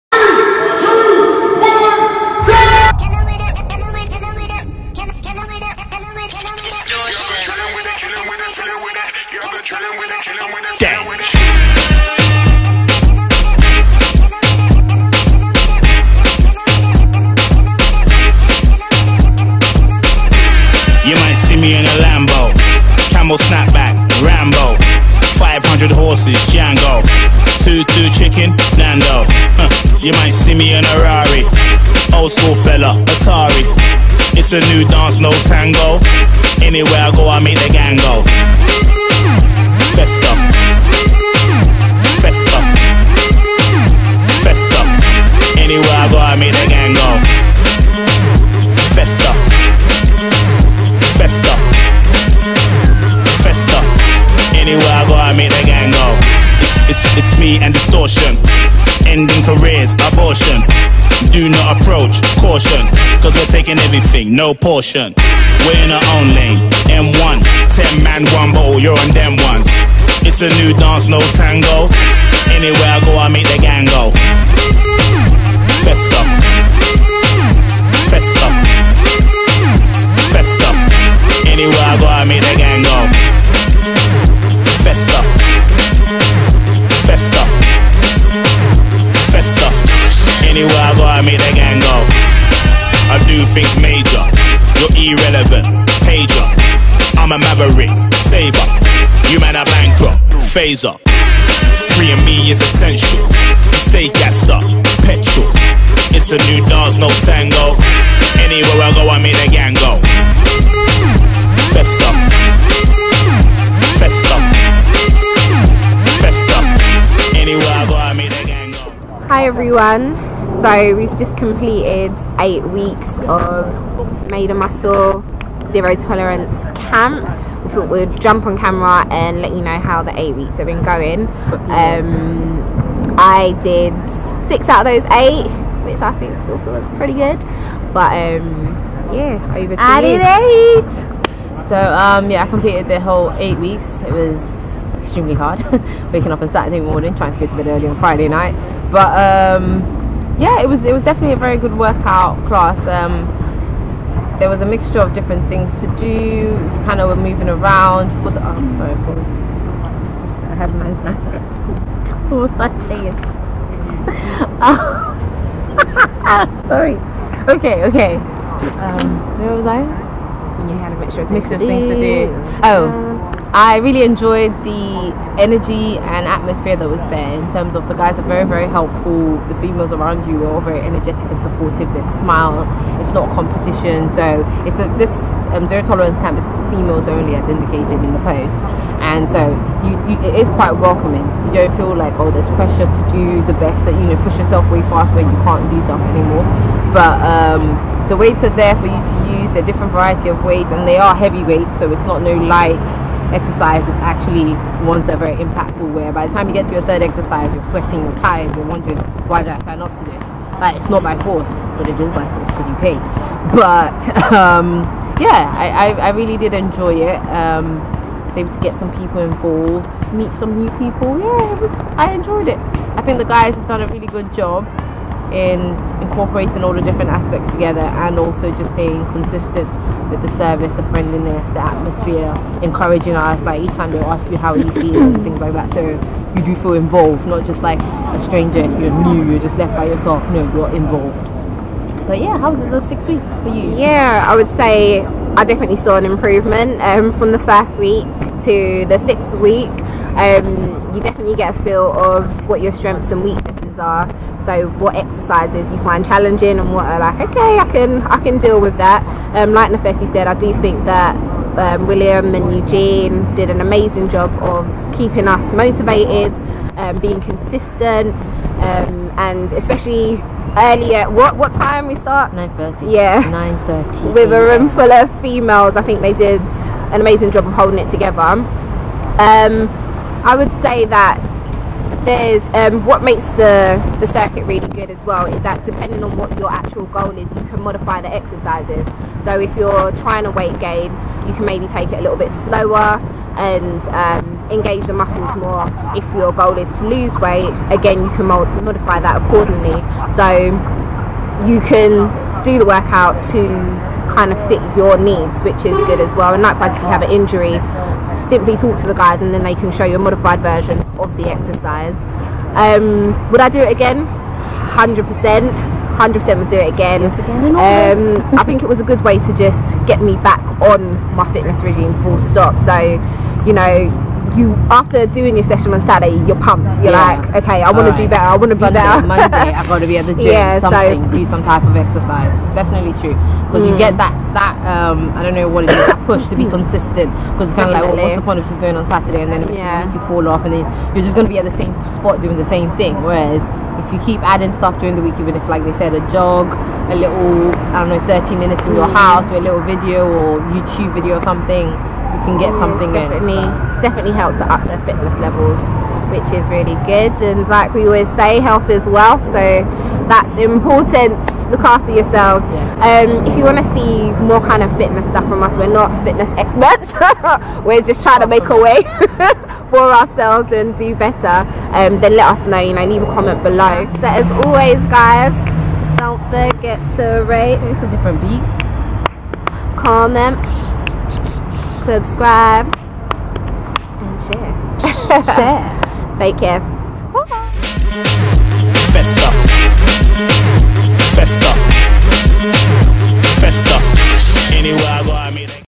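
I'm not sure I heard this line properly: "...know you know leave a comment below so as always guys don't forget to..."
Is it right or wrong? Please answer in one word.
right.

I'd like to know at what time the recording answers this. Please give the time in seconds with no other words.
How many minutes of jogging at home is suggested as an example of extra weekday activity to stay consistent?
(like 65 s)
348 s.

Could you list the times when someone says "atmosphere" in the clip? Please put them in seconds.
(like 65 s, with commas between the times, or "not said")
176 s, 231 s.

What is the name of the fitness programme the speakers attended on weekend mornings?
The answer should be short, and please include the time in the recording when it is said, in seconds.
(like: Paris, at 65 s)
Made of Muscle Zero Tolerance Camp, at 124 s.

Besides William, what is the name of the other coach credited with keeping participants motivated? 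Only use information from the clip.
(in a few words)
Eugene.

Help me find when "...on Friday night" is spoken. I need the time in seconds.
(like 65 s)
147 s.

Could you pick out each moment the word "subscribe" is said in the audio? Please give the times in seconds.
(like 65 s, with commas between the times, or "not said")
381 s.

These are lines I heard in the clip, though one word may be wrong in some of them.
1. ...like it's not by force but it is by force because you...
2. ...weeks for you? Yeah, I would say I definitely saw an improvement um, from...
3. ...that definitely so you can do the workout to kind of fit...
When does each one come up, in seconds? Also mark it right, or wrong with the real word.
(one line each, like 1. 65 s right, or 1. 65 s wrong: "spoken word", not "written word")
1. 210 s right
2. 243 s right
3. 298 s wrong: "accordingly", not "definitely".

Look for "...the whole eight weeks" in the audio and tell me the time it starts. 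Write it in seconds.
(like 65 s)
142 s.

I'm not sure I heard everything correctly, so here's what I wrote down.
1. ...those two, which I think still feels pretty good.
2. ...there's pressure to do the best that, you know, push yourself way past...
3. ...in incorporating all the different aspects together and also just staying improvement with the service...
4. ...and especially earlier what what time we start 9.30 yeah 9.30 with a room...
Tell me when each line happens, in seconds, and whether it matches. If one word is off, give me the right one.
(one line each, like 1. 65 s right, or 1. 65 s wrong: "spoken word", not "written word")
1. 135 s wrong: "eight", not "two"
2. 192 s right
3. 225 s wrong: "consistent", not "improvement"
4. 269 s right.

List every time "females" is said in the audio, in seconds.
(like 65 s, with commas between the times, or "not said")
179 s, 186 s, 275 s.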